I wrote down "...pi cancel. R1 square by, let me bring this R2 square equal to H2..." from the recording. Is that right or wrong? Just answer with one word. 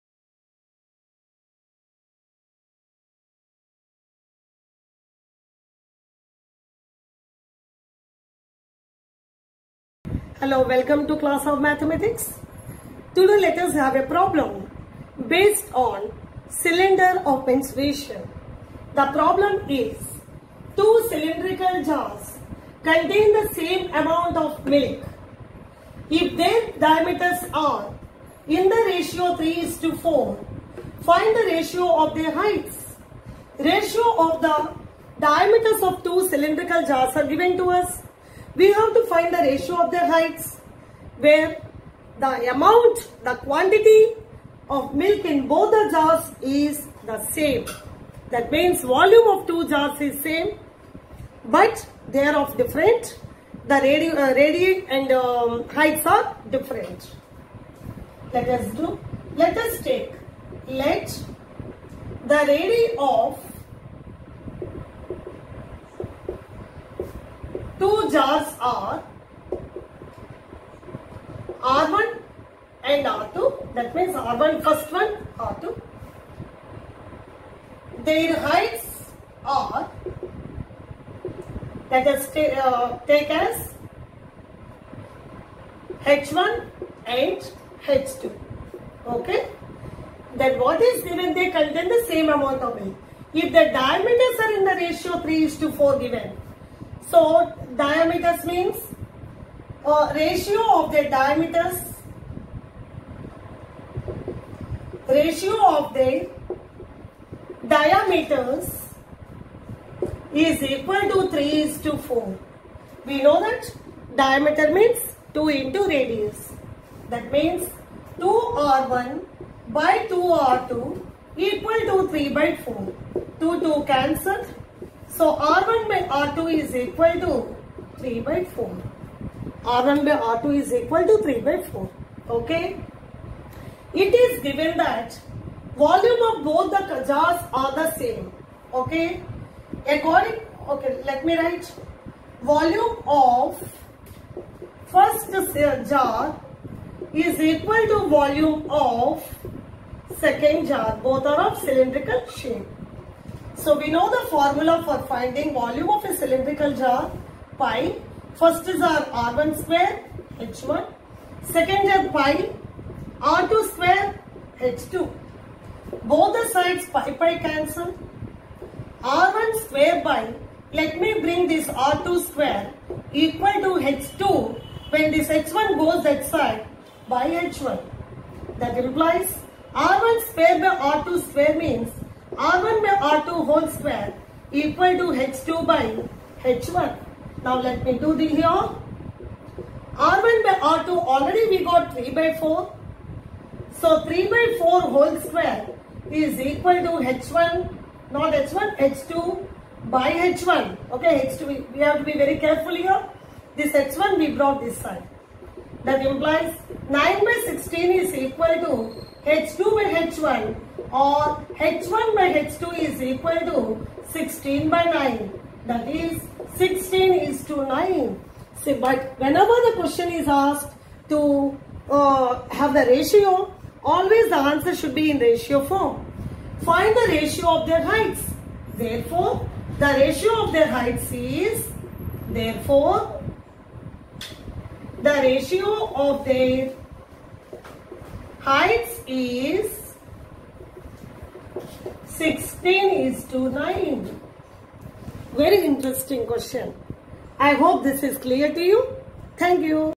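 right.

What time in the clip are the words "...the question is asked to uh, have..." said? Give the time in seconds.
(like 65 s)
219 s.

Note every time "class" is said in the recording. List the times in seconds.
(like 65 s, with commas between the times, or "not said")
11 s.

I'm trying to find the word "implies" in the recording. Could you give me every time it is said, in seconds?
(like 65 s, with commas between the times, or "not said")
178 s, 206 s.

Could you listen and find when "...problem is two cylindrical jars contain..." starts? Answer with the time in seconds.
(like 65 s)
19 s.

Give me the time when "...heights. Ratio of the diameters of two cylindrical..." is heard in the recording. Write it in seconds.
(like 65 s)
32 s.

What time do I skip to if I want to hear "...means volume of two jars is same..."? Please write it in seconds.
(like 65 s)
48 s.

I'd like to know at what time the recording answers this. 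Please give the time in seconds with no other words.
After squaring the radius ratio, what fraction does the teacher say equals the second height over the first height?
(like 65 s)
206 s.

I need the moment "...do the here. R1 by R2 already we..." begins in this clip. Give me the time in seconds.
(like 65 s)
187 s.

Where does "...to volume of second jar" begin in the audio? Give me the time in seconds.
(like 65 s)
147 s.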